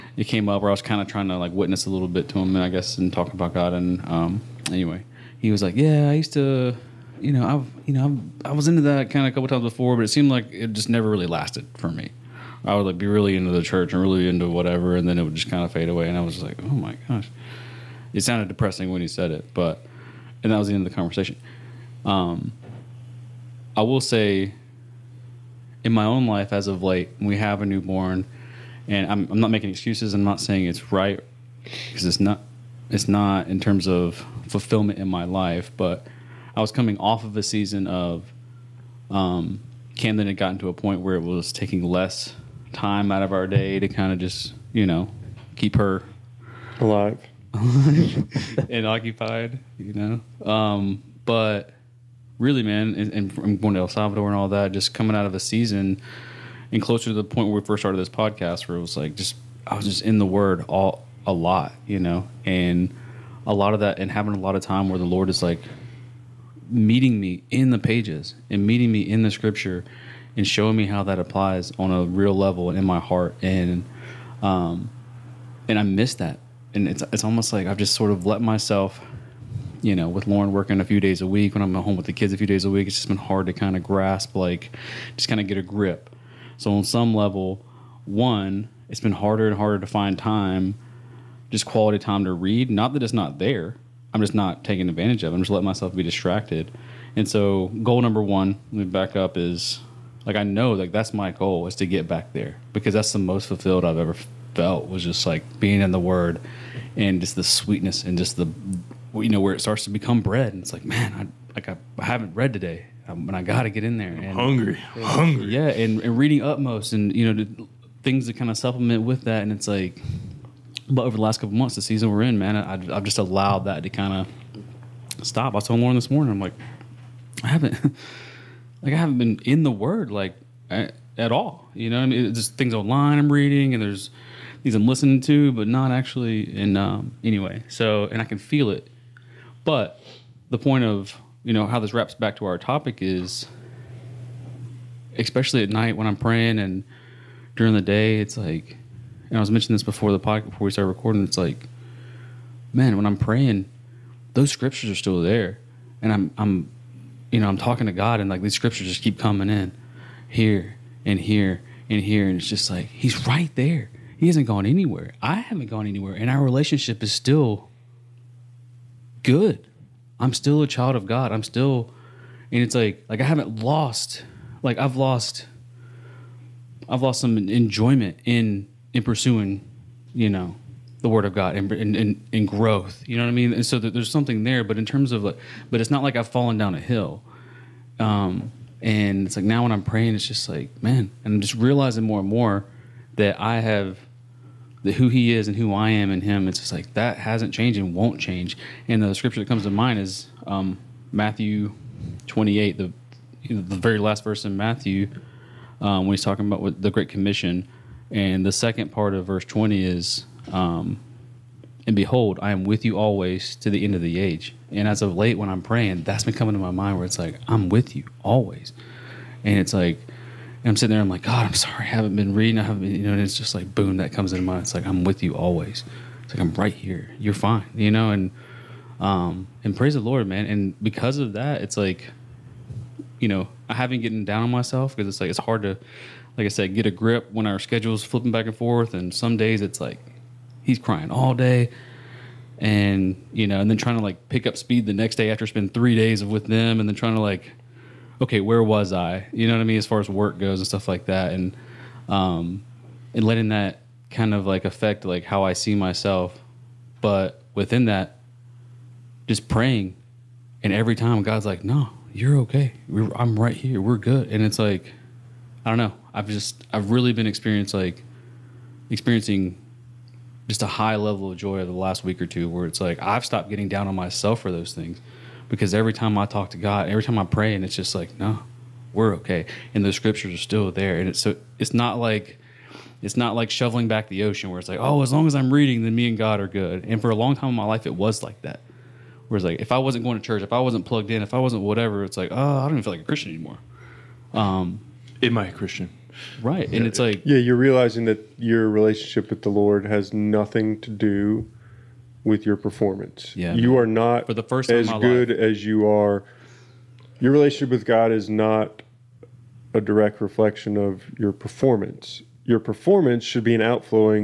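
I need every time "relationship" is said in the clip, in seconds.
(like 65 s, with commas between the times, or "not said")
166 s, 298 s, 307 s.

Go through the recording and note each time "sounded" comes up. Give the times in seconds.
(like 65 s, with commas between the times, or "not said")
18 s.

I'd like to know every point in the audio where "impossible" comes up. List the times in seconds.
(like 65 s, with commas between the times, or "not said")
not said.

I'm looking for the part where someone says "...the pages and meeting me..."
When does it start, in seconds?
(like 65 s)
67 s.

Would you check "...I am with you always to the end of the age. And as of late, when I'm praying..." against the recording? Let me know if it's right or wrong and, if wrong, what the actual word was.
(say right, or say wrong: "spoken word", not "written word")
right.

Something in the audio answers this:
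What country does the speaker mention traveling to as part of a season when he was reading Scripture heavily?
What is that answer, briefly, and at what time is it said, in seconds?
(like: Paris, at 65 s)
El Salvador, at 53 s.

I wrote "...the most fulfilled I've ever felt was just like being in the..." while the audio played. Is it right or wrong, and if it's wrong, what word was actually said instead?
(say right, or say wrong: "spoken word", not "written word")
right.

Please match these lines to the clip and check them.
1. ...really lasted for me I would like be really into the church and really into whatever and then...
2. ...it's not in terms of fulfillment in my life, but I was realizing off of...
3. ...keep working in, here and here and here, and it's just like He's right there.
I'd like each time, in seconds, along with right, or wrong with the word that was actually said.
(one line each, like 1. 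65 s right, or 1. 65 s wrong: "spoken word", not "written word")
1. 11 s right
2. 32 s wrong: "coming", not "realizing"
3. 159 s wrong: "coming", not "working".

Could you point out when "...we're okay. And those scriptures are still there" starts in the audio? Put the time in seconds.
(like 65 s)
278 s.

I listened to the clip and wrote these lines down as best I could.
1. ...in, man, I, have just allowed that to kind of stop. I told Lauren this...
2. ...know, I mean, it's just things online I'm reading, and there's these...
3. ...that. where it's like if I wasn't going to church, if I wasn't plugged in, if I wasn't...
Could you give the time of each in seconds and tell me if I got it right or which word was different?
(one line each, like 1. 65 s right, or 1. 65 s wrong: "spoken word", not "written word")
1. 122 s right
2. 131 s right
3. 288 s right.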